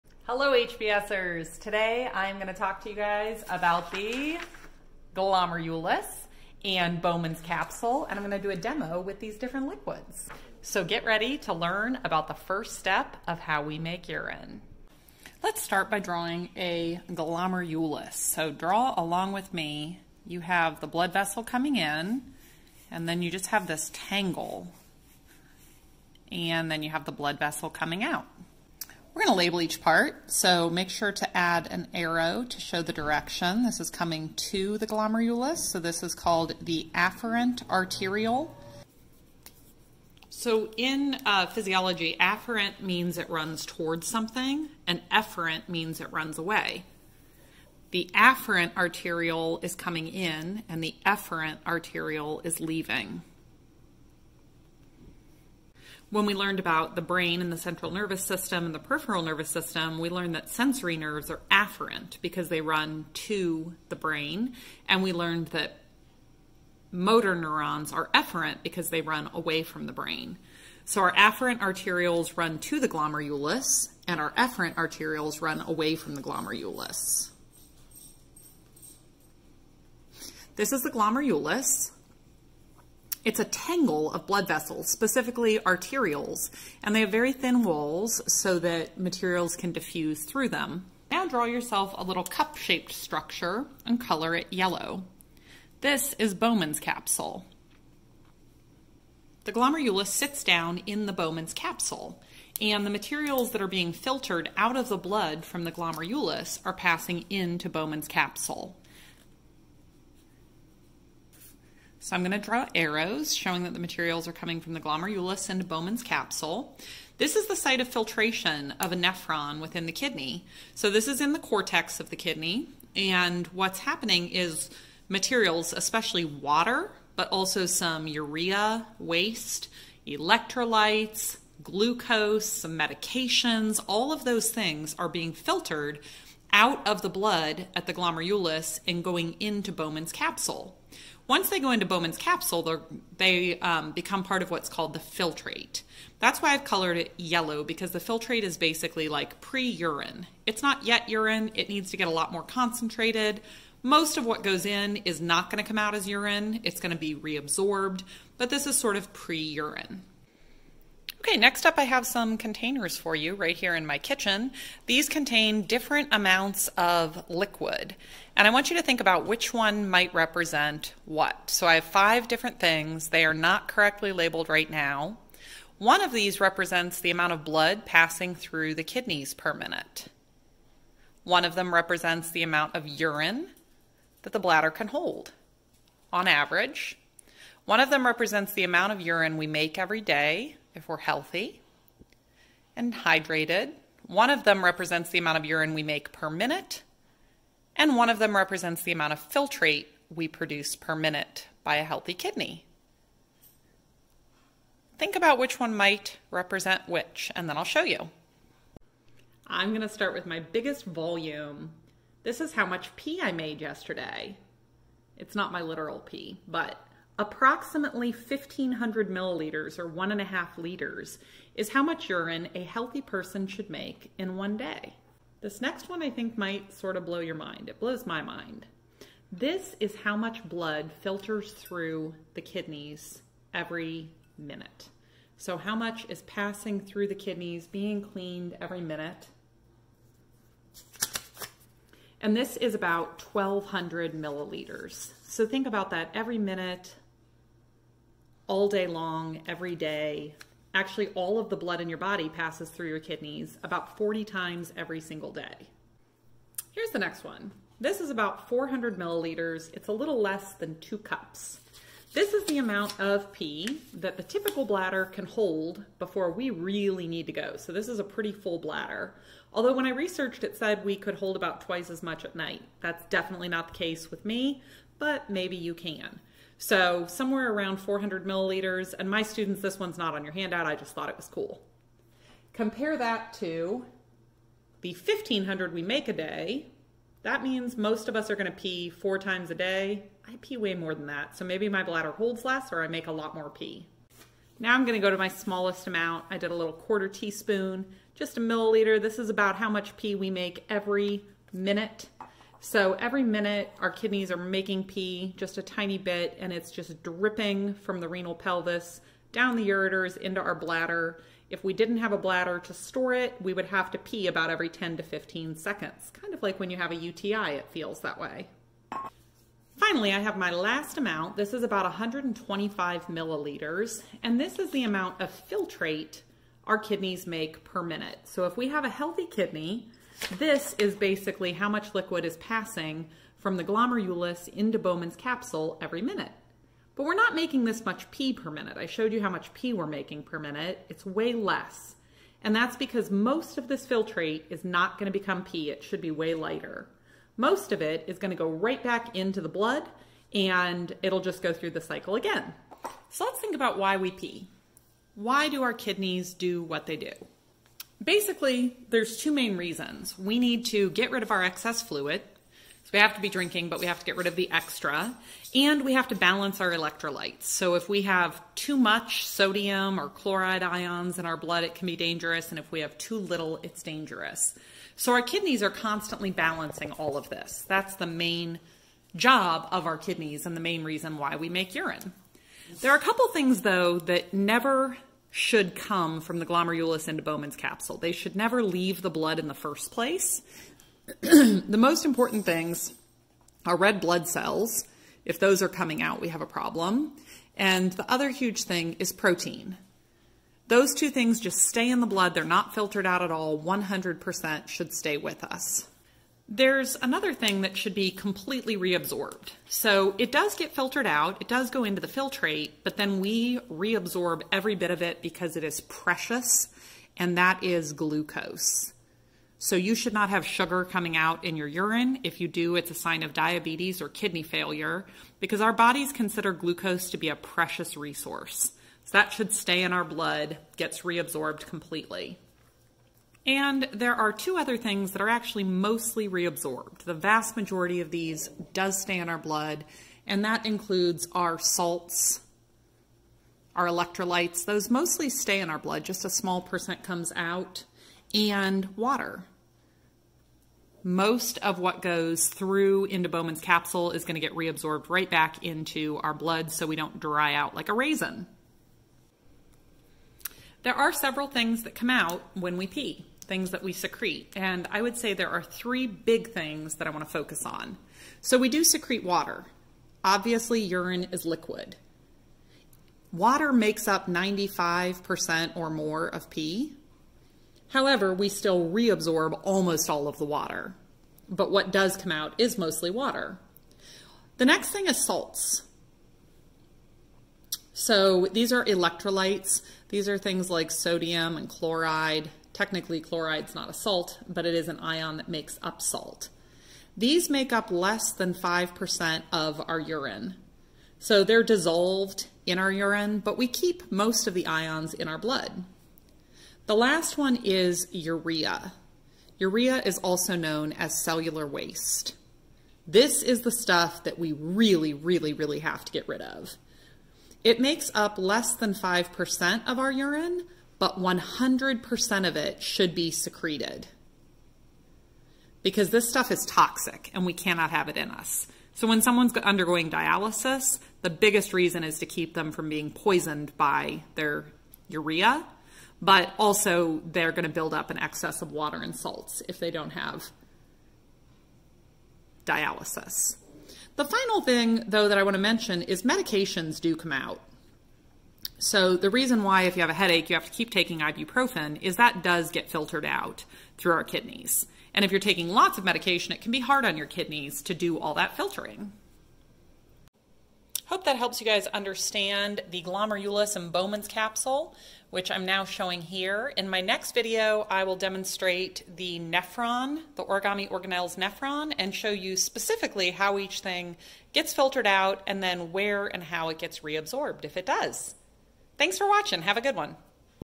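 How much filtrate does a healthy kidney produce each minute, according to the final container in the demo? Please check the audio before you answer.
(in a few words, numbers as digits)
125 milliliters.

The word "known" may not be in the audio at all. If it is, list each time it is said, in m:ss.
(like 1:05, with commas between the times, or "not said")
8:30.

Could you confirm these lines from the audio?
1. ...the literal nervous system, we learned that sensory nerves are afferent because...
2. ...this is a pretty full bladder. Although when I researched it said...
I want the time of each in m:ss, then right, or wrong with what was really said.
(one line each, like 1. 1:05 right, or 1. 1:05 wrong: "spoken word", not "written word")
1. 0:58 wrong: "peripheral", not "literal"
2. 4:27 right.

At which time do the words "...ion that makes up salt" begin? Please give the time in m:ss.
8:14.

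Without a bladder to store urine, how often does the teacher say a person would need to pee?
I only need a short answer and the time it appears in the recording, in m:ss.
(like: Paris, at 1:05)
every 10 to 15 seconds, at 5:14.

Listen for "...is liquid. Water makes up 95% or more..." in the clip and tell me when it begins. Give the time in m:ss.
7:51.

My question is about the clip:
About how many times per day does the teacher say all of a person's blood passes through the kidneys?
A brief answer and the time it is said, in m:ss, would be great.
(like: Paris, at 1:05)
40 times, at 4:13.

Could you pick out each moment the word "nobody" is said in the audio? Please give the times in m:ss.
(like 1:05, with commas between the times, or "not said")
not said.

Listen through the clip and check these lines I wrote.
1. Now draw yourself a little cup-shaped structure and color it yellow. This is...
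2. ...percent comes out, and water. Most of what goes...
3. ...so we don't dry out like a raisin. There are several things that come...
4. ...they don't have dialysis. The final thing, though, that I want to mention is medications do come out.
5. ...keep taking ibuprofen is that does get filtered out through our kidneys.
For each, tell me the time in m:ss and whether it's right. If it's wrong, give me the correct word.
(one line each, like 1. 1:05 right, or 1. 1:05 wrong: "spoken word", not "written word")
1. 1:31 right
2. 7:26 right
3. 7:36 right
4. 8:59 right
5. 9:10 right.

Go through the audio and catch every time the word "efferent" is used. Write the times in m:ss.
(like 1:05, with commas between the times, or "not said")
0:45, 0:51, 1:08, 1:14.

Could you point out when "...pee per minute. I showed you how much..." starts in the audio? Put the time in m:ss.
5:38.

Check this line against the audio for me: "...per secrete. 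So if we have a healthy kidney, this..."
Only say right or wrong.
wrong.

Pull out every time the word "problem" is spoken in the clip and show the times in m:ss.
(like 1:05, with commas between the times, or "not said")
6:36.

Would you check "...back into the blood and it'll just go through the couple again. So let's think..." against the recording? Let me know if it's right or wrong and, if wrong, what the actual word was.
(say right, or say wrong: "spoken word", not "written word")
wrong: "cycle", not "couple".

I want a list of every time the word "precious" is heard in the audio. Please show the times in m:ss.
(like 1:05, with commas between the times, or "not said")
6:55, 7:07.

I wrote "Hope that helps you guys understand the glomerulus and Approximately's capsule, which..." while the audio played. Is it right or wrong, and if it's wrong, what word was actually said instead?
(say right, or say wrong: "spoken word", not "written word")
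wrong: "Bowman", not "Approximately".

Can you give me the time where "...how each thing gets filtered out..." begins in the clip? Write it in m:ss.
9:33.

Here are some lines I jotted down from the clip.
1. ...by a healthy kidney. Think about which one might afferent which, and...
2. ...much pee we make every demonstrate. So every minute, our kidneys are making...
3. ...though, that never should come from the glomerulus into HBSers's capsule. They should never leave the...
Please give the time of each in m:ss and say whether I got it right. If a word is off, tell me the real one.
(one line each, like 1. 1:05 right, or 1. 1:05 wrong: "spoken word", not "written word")
1. 3:21 wrong: "represent", not "afferent"
2. 4:59 wrong: "minute", not "demonstrate"
3. 6:23 wrong: "Bowman", not "HBSers".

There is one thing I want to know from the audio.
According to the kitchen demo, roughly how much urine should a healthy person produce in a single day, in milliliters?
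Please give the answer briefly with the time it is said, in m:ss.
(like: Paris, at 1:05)
1,500 milliliters, at 3:38.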